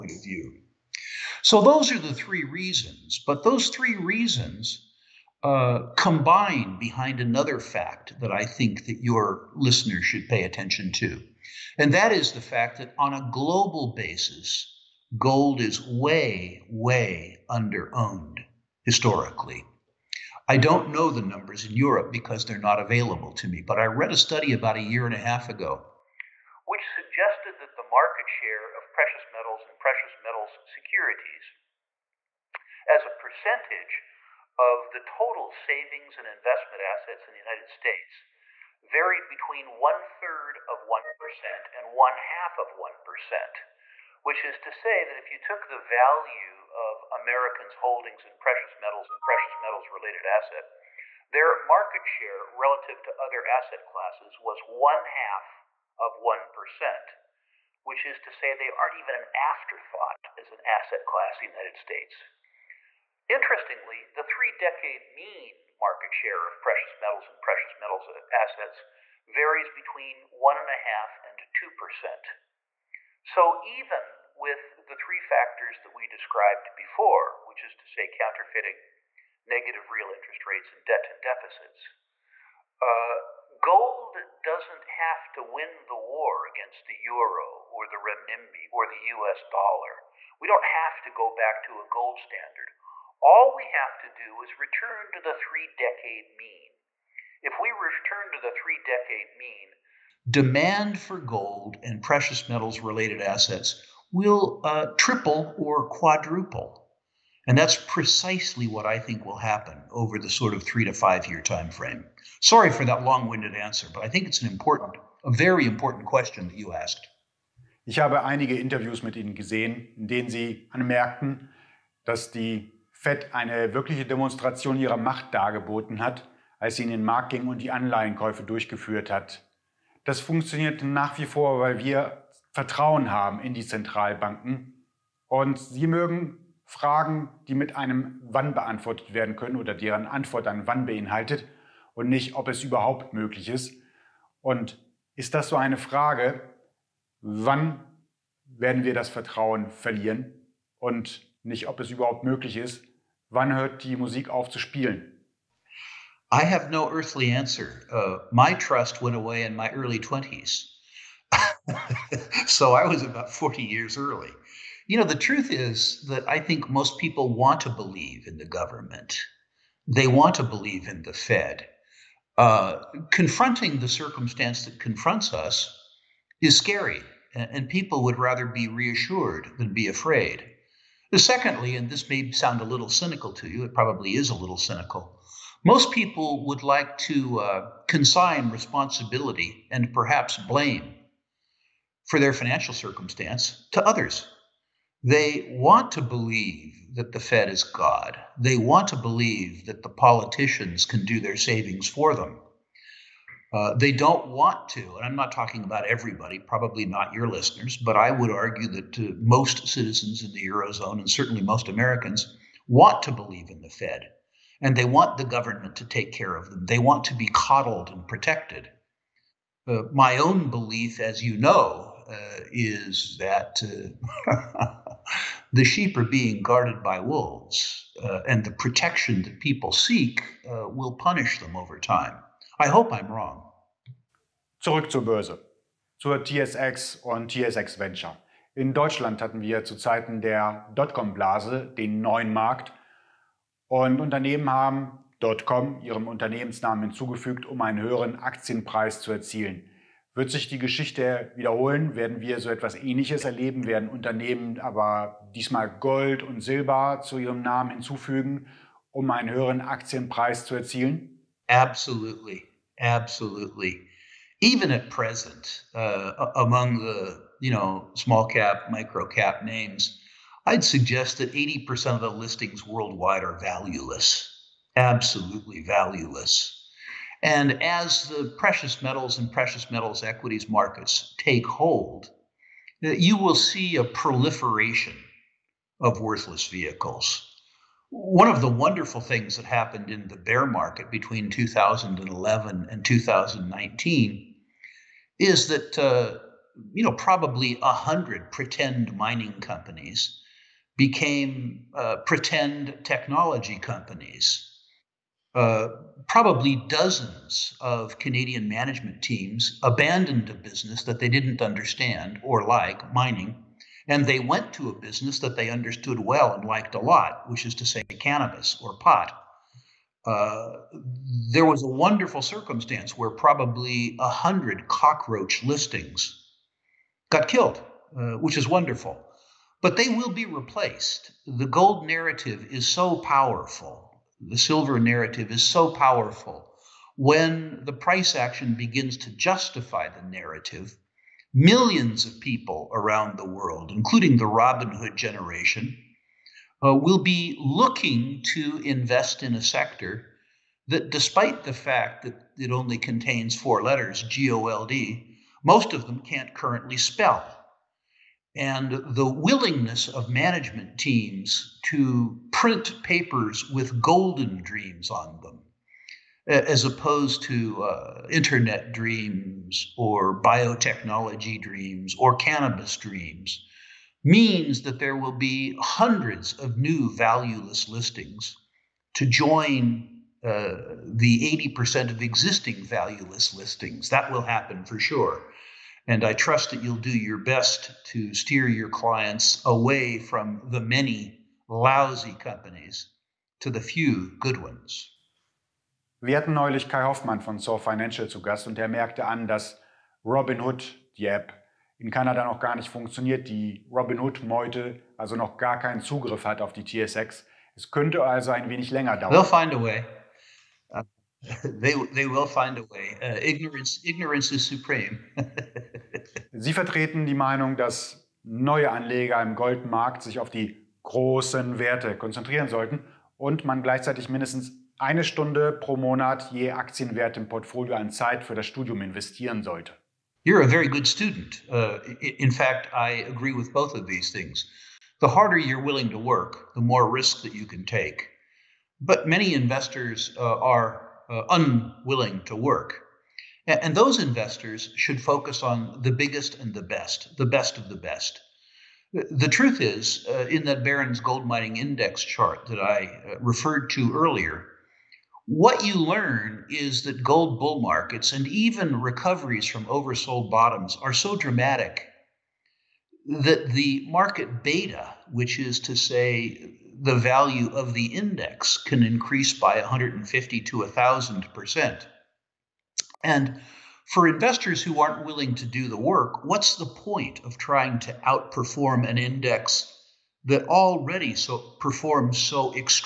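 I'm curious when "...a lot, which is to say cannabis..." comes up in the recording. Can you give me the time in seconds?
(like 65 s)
316 s.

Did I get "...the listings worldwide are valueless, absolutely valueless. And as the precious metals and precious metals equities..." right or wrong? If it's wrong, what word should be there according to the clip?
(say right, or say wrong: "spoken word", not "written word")
right.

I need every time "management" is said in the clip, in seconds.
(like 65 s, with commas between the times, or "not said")
308 s, 360 s.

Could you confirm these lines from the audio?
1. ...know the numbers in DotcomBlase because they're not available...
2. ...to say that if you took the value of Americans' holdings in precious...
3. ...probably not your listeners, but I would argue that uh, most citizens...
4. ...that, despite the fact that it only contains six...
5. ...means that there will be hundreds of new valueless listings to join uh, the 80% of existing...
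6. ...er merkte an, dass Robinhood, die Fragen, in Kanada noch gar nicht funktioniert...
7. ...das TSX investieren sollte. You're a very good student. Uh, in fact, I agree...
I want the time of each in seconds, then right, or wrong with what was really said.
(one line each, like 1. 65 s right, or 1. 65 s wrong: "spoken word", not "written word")
1. 20 s wrong: "Europe", not "DotcomBlase"
2. 44 s right
3. 206 s right
4. 350 s wrong: "four", not "six"
5. 374 s right
6. 398 s wrong: "App", not "Fragen"
7. 428 s wrong: "Studium", not "TSX".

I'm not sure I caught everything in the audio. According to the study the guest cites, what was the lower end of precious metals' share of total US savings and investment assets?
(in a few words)
one third of 1%.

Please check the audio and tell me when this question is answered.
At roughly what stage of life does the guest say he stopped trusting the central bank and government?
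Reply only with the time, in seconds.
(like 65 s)
159 s.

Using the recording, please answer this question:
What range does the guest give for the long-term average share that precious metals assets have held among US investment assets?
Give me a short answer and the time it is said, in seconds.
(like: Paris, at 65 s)
1.5 to 2%, at 70 s.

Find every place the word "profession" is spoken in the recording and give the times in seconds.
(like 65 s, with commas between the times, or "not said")
not said.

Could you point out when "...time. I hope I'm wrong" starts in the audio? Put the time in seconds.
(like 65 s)
231 s.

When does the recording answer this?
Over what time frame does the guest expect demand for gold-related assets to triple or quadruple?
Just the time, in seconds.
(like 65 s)
110 s.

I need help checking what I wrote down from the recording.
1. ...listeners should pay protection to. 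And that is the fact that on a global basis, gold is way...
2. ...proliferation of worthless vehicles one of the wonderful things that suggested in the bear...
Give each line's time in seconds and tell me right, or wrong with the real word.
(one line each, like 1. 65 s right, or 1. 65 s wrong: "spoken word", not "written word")
1. 9 s wrong: "attention", not "protection"
2. 283 s wrong: "happened", not "suggested".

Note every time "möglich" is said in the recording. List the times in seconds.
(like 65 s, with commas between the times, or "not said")
143 s, 152 s.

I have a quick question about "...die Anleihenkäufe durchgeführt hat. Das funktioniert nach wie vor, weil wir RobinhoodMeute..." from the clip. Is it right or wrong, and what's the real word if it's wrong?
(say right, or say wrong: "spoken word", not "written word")
wrong: "Vertrauen", not "RobinhoodMeute".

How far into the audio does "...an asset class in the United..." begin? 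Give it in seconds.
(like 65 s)
60 s.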